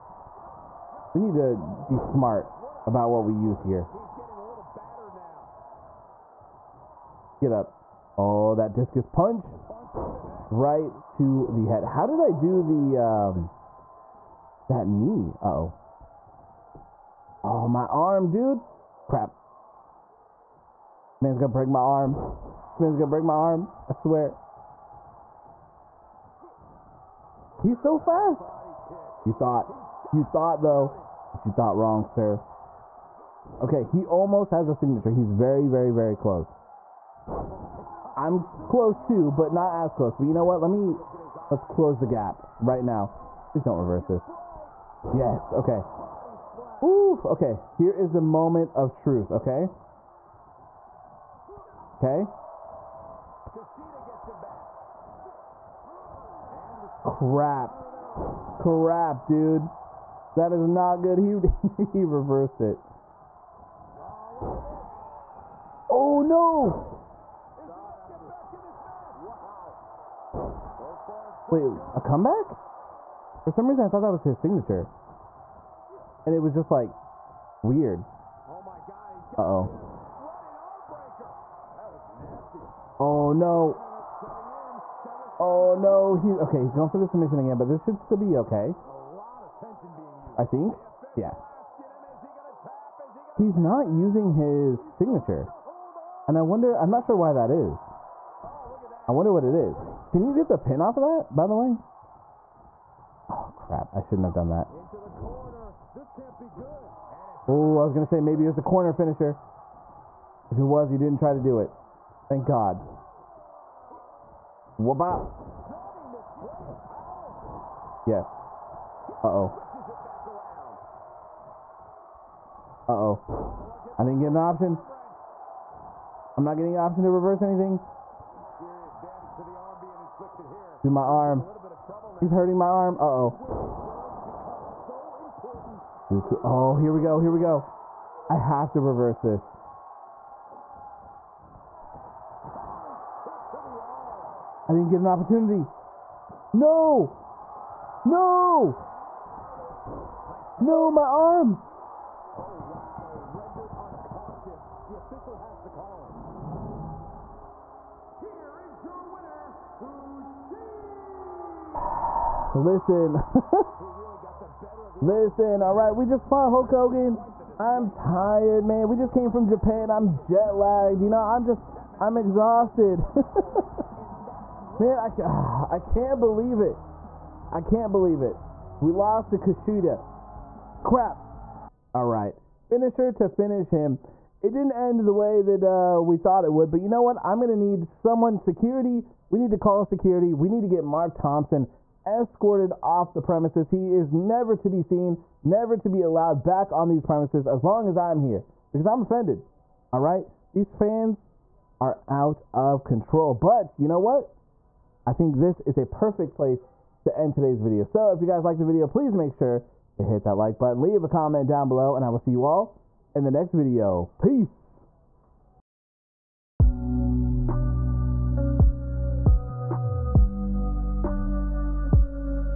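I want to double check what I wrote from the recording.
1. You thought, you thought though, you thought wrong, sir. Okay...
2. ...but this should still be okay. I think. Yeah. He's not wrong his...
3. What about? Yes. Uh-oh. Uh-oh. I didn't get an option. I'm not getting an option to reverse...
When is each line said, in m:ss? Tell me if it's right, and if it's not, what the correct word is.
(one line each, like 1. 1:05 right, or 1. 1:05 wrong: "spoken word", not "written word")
1. 0:29 right
2. 1:27 wrong: "using", not "wrong"
3. 1:54 right.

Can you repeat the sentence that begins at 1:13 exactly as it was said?
For some reason, I thought that was his signature.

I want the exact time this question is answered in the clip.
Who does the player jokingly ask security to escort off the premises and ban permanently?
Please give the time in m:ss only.
3:10.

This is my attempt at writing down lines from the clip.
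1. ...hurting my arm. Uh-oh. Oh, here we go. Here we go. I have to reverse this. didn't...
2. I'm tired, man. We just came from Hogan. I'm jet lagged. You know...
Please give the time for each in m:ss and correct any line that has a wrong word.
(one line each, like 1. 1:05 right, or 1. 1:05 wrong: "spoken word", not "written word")
1. 2:12 right
2. 2:47 wrong: "Japan", not "Hogan".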